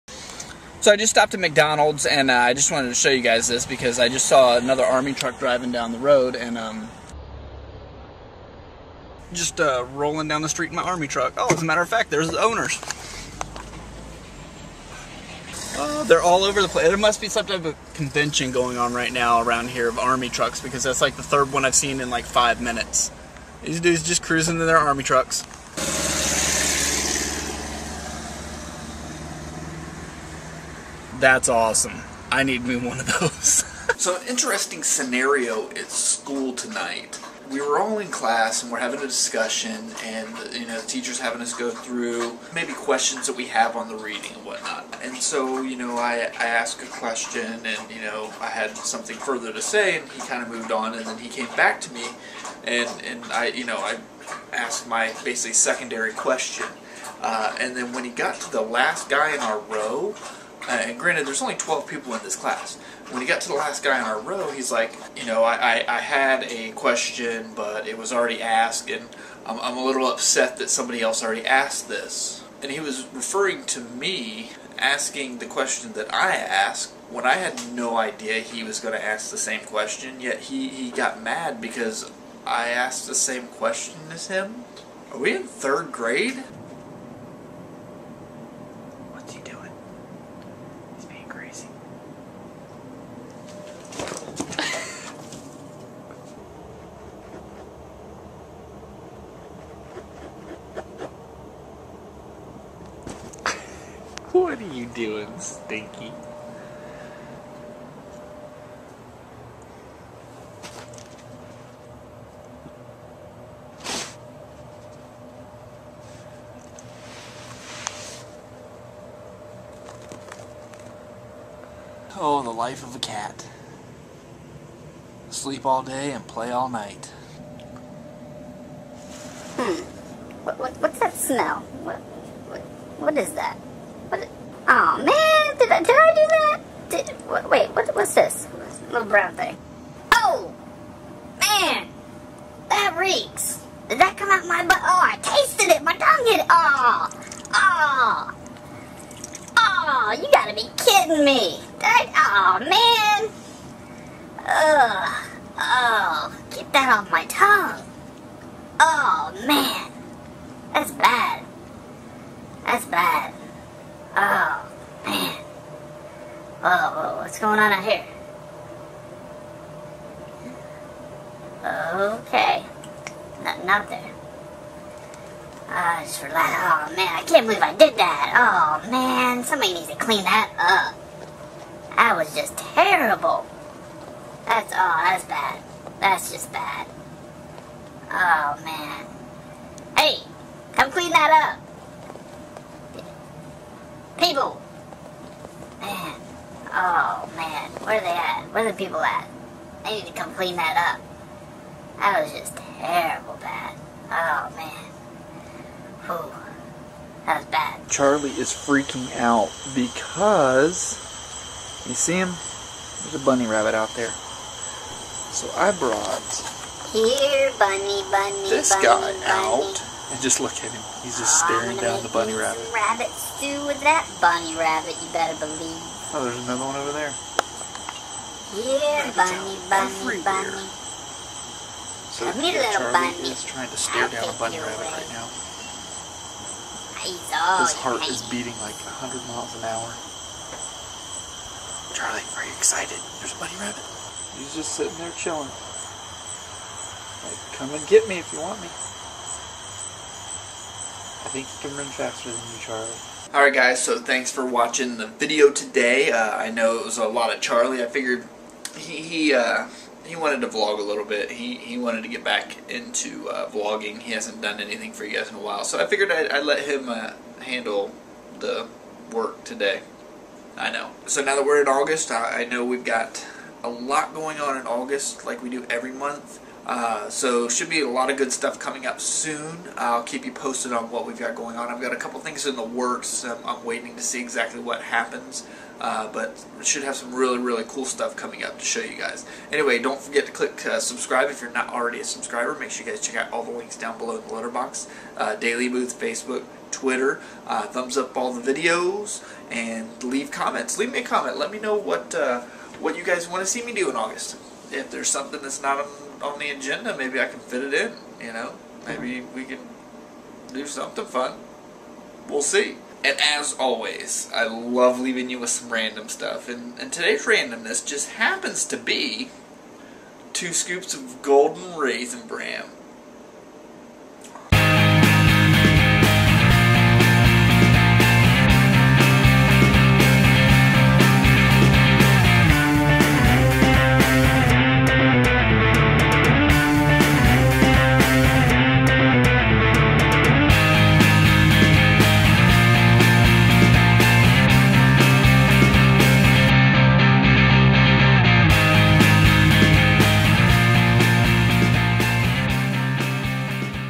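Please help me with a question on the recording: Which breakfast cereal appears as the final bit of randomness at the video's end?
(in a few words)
golden raisin bran.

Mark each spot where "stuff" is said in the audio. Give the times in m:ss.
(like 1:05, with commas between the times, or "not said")
4:38, 4:47, 5:16.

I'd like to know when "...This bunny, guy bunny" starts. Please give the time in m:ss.
3:38.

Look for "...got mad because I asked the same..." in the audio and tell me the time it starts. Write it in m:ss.
1:20.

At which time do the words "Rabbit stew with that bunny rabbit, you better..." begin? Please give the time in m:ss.
3:42.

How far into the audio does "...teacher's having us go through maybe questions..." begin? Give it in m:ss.
0:40.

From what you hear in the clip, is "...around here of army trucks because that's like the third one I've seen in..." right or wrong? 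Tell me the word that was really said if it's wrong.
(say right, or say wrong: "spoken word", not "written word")
right.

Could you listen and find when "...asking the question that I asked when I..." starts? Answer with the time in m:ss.
1:14.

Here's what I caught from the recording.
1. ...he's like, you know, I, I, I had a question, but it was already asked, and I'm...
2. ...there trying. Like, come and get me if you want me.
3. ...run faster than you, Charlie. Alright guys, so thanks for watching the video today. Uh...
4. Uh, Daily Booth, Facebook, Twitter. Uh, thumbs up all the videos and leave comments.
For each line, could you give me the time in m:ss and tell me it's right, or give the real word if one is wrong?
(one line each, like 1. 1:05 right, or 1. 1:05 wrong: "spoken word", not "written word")
1. 1:04 right
2. 4:04 wrong: "chilling", not "trying"
3. 4:11 right
4. 4:55 right.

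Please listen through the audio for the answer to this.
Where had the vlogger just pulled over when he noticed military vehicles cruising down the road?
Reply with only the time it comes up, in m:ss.
0:01.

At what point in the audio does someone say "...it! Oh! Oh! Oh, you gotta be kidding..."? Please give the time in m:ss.
2:26.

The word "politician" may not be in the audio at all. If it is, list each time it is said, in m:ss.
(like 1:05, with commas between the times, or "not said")
not said.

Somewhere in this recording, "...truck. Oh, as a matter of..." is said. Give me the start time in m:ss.
0:11.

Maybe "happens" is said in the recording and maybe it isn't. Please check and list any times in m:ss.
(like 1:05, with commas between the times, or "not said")
4:44, 5:18.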